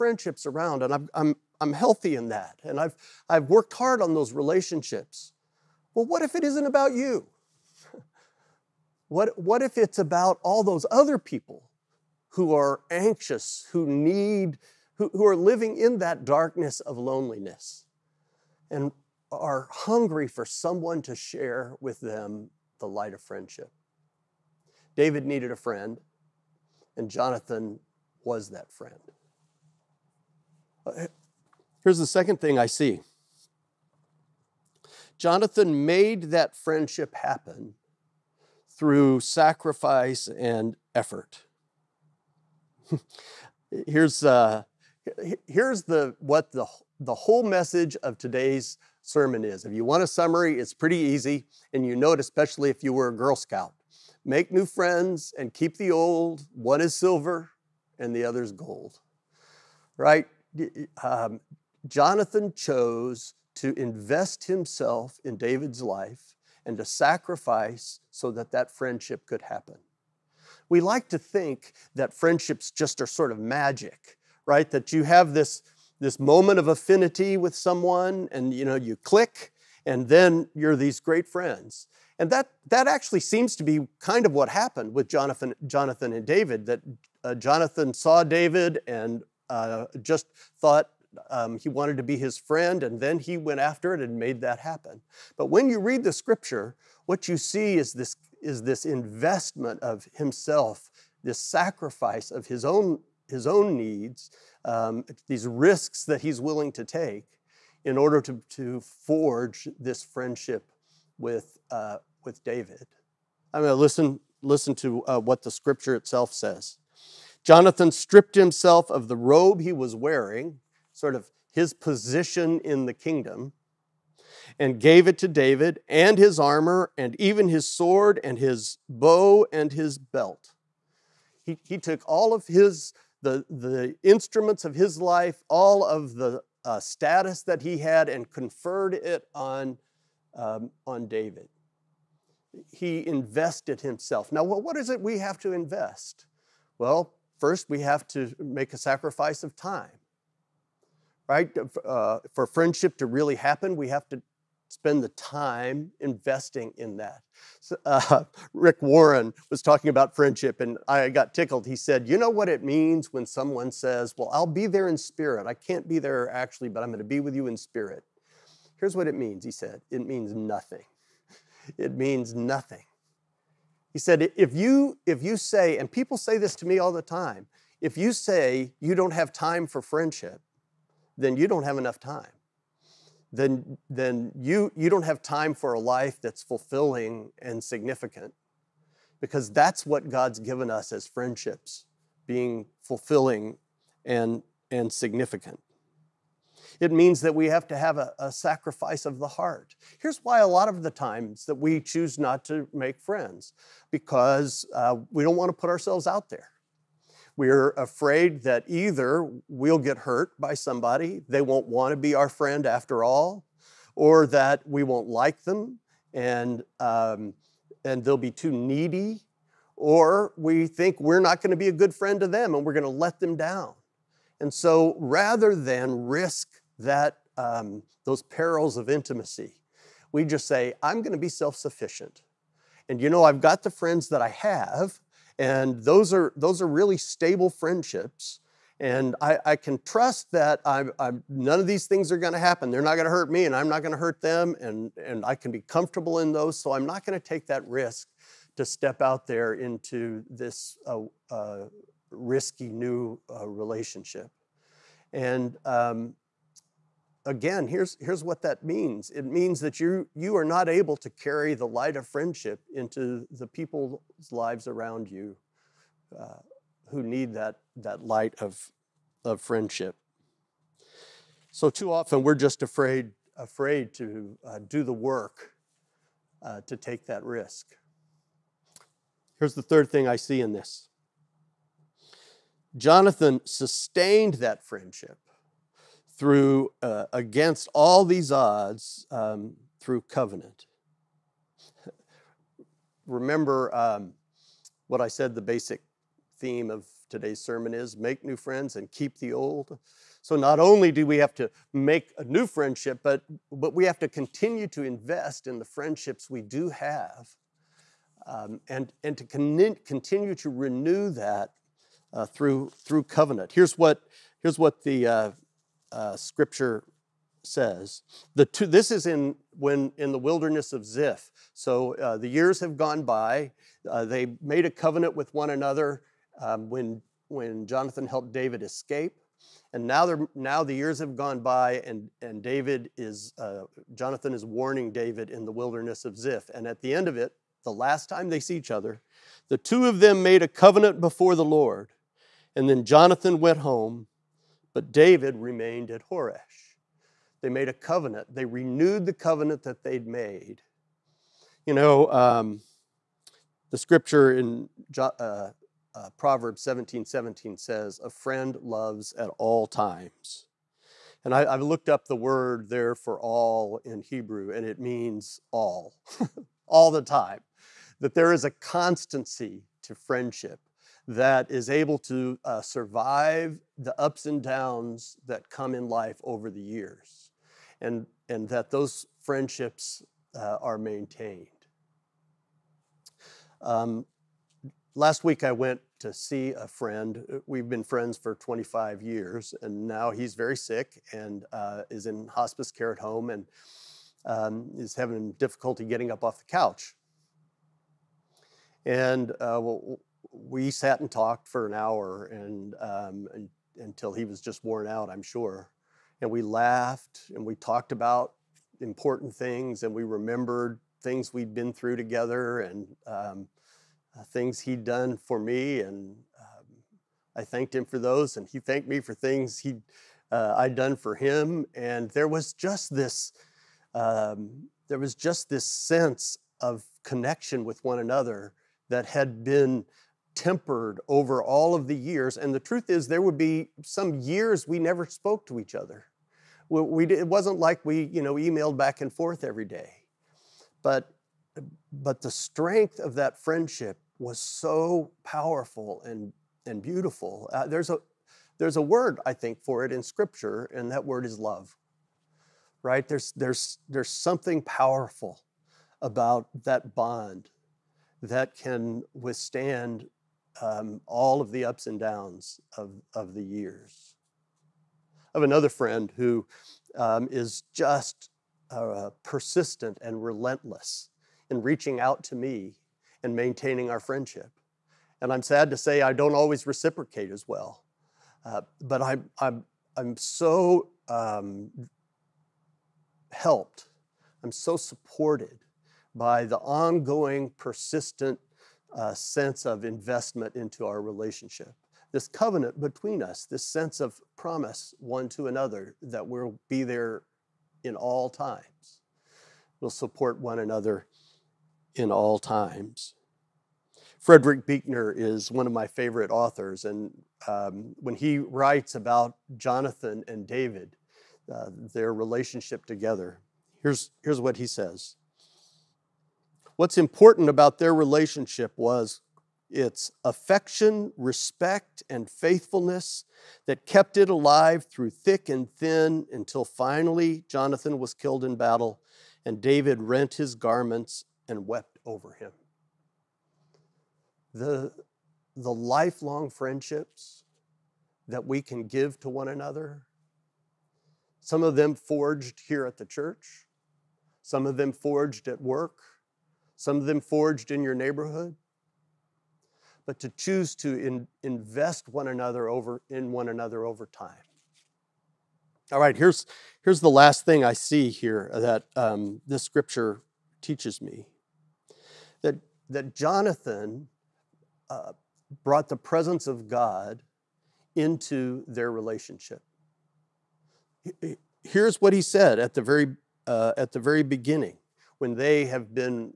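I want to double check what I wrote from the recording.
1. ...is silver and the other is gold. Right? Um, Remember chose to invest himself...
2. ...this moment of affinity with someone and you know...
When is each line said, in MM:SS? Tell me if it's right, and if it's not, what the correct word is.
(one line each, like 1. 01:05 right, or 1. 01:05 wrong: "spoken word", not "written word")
1. 00:56 wrong: "Jonathan", not "Remember"
2. 01:15 right.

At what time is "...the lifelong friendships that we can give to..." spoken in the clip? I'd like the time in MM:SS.
08:55.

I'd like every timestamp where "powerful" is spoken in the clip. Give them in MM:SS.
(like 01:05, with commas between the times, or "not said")
07:25, 07:34.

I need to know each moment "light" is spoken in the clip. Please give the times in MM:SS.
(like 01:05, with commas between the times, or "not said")
00:22, 04:21, 04:28.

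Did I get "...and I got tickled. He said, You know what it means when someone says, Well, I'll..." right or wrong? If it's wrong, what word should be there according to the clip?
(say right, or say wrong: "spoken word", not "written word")
right.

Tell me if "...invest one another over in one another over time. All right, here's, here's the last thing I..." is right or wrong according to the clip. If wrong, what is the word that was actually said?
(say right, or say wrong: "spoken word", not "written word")
right.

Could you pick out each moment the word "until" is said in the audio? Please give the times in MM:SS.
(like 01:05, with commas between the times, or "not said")
06:43, 08:46.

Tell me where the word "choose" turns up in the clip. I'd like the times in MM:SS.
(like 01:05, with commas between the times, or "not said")
03:21, 09:10.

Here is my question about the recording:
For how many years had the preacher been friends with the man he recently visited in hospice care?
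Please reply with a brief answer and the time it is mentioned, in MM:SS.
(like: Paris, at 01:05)
25, at 06:28.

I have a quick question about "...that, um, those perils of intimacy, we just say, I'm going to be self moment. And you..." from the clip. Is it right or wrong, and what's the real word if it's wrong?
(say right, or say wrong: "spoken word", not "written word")
wrong: "sufficient", not "moment".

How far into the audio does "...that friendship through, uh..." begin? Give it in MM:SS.
04:44.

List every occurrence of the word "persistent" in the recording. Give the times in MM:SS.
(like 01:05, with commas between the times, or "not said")
07:49, 08:07.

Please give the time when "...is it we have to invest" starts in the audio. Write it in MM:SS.
02:24.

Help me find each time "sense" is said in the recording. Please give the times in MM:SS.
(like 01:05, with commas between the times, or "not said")
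07:05, 08:09, 08:13.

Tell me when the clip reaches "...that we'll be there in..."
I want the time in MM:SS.
08:16.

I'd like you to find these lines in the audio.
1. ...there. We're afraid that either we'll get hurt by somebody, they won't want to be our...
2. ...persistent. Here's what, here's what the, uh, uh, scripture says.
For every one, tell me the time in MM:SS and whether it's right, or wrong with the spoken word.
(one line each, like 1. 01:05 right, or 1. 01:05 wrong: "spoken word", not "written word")
1. 03:26 right
2. 05:13 wrong: "covenant", not "persistent".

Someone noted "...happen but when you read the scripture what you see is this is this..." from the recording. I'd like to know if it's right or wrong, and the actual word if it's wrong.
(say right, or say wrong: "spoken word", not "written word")
right.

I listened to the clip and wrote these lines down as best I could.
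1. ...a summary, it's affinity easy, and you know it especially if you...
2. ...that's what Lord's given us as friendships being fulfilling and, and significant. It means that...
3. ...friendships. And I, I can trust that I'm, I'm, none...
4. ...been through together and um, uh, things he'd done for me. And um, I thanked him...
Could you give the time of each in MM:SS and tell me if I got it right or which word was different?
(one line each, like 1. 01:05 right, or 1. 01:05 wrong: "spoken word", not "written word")
1. 00:50 wrong: "pretty", not "affinity"
2. 03:09 wrong: "God", not "Lord"
3. 03:57 right
4. 06:51 right.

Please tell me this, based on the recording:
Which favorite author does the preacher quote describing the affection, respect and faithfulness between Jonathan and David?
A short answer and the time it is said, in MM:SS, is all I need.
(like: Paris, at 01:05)
Frederick Buechner, at 08:24.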